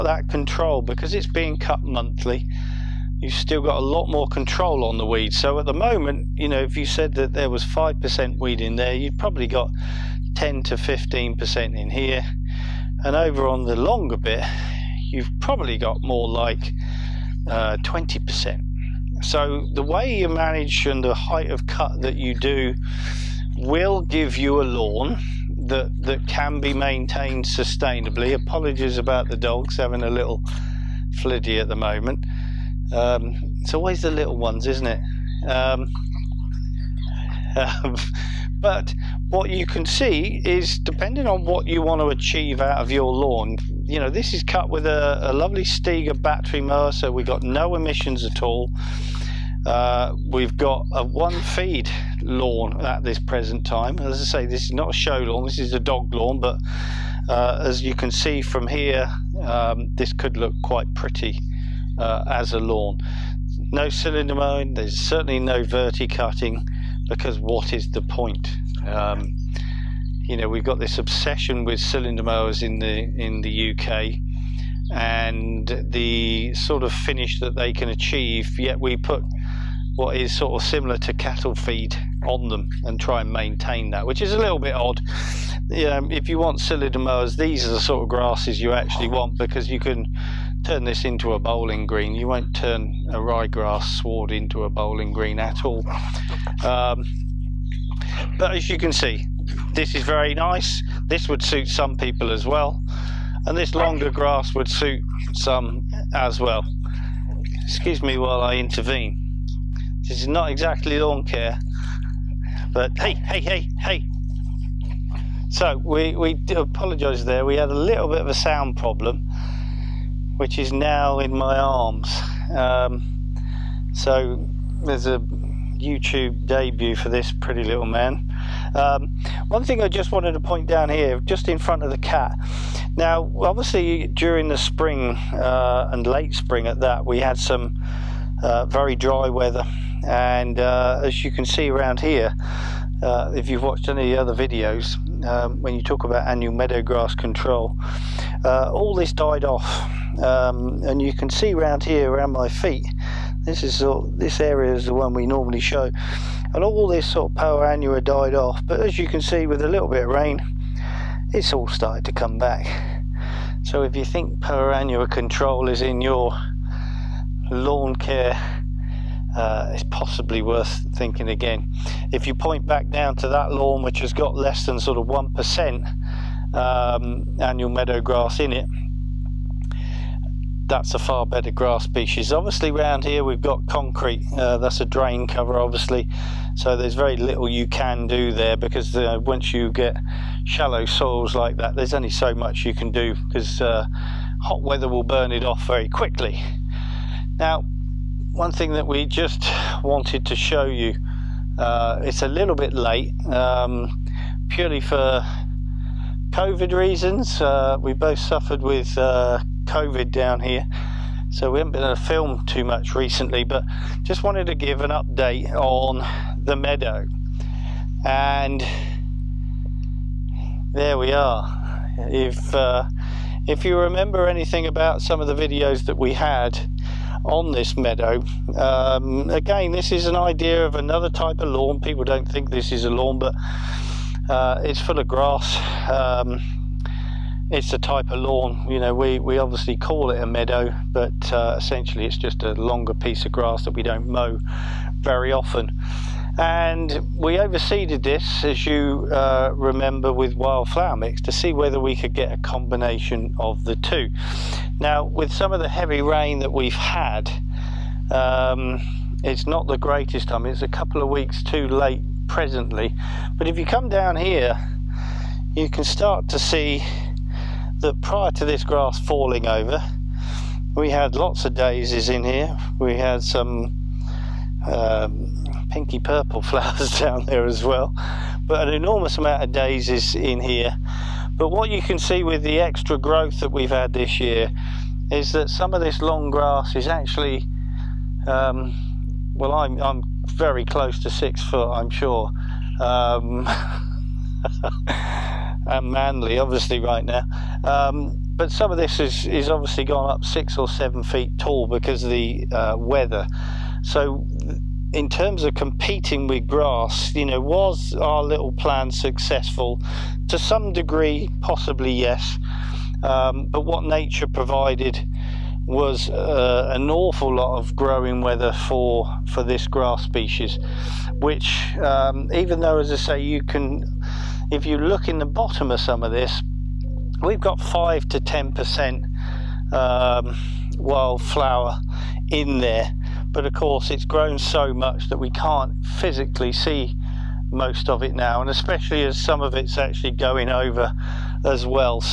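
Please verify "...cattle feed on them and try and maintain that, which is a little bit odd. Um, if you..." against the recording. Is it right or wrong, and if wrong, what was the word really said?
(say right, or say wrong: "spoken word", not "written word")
right.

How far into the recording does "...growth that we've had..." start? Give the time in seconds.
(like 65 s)
282 s.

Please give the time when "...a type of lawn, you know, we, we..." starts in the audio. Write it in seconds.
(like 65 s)
237 s.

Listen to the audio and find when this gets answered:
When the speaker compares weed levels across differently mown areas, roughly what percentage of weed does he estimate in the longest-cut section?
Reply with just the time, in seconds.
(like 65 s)
17 s.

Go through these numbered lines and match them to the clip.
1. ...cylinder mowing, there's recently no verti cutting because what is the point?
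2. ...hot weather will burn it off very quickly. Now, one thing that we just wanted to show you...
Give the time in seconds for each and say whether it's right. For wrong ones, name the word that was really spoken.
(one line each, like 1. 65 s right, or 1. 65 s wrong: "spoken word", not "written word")
1. 63 s wrong: "certainly", not "recently"
2. 194 s right.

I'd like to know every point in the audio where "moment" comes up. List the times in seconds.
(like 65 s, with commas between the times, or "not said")
5 s, 31 s.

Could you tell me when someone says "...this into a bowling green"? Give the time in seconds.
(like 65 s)
90 s.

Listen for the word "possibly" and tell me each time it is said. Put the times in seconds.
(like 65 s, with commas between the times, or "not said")
169 s, 311 s.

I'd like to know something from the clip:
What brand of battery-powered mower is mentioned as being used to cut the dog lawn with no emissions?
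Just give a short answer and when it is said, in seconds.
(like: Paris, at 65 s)
Stiga, at 45 s.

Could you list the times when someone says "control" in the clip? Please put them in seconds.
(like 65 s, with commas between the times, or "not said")
0 s, 4 s, 147 s, 165 s.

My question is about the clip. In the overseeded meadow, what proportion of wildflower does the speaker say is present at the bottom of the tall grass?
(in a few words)
5 to 10%.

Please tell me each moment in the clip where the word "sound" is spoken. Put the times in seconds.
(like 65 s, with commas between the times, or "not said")
118 s.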